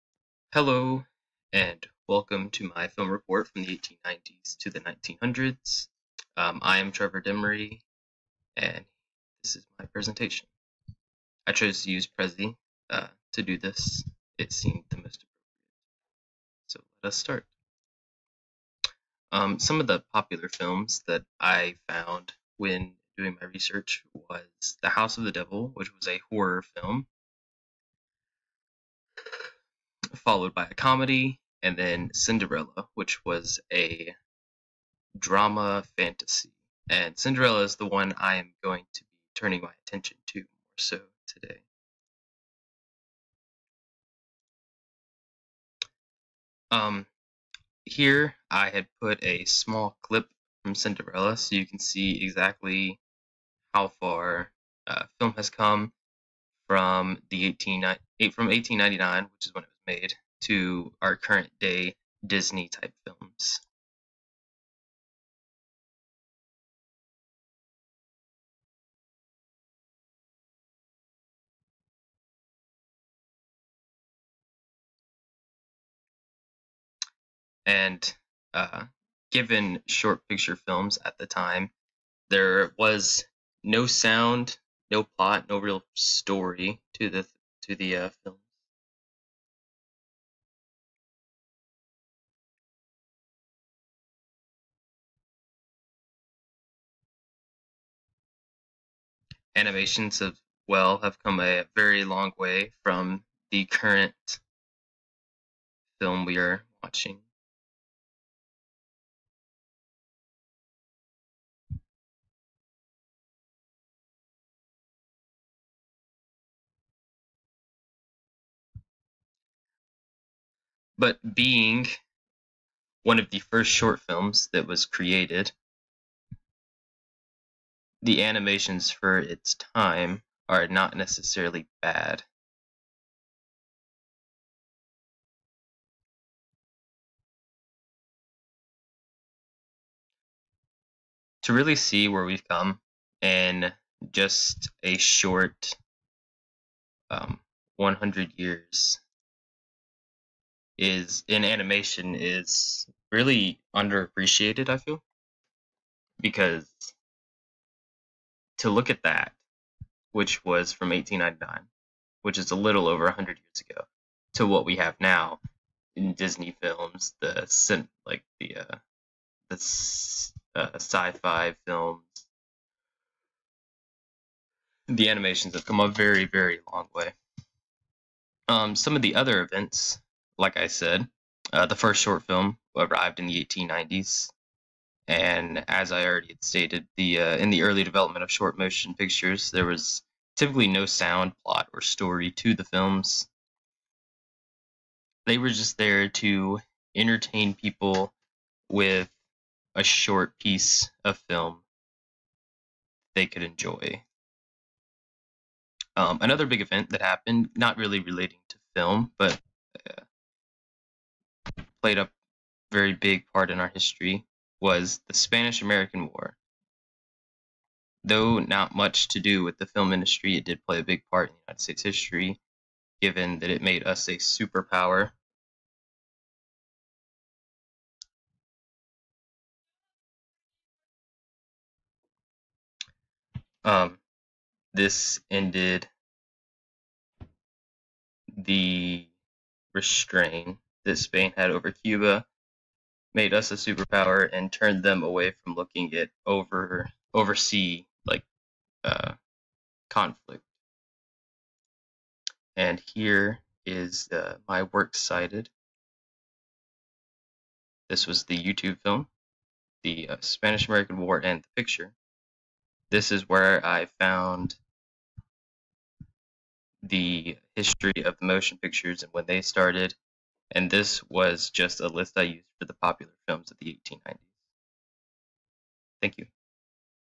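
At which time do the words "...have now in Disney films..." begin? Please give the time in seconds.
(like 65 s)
164 s.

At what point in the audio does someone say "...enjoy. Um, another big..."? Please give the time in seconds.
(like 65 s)
203 s.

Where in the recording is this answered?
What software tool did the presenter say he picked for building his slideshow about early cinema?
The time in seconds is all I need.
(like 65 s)
12 s.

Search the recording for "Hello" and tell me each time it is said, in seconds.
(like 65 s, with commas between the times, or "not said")
0 s.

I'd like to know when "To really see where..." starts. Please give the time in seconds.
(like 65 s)
141 s.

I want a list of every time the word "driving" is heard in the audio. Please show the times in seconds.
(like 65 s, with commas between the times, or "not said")
not said.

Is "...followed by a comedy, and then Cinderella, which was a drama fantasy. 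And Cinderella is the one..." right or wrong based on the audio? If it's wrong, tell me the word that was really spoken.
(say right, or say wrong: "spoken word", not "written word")
right.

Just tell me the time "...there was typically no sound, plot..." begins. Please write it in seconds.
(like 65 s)
189 s.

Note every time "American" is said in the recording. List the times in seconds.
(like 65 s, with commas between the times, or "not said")
215 s, 260 s.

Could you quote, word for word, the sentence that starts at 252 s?
And here is uh, my works cited.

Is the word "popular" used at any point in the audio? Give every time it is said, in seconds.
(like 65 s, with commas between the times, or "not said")
20 s, 272 s.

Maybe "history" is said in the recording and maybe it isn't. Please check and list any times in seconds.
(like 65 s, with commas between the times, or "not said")
213 s, 221 s, 267 s.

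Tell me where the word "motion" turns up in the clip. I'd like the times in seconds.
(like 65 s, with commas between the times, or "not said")
188 s, 268 s.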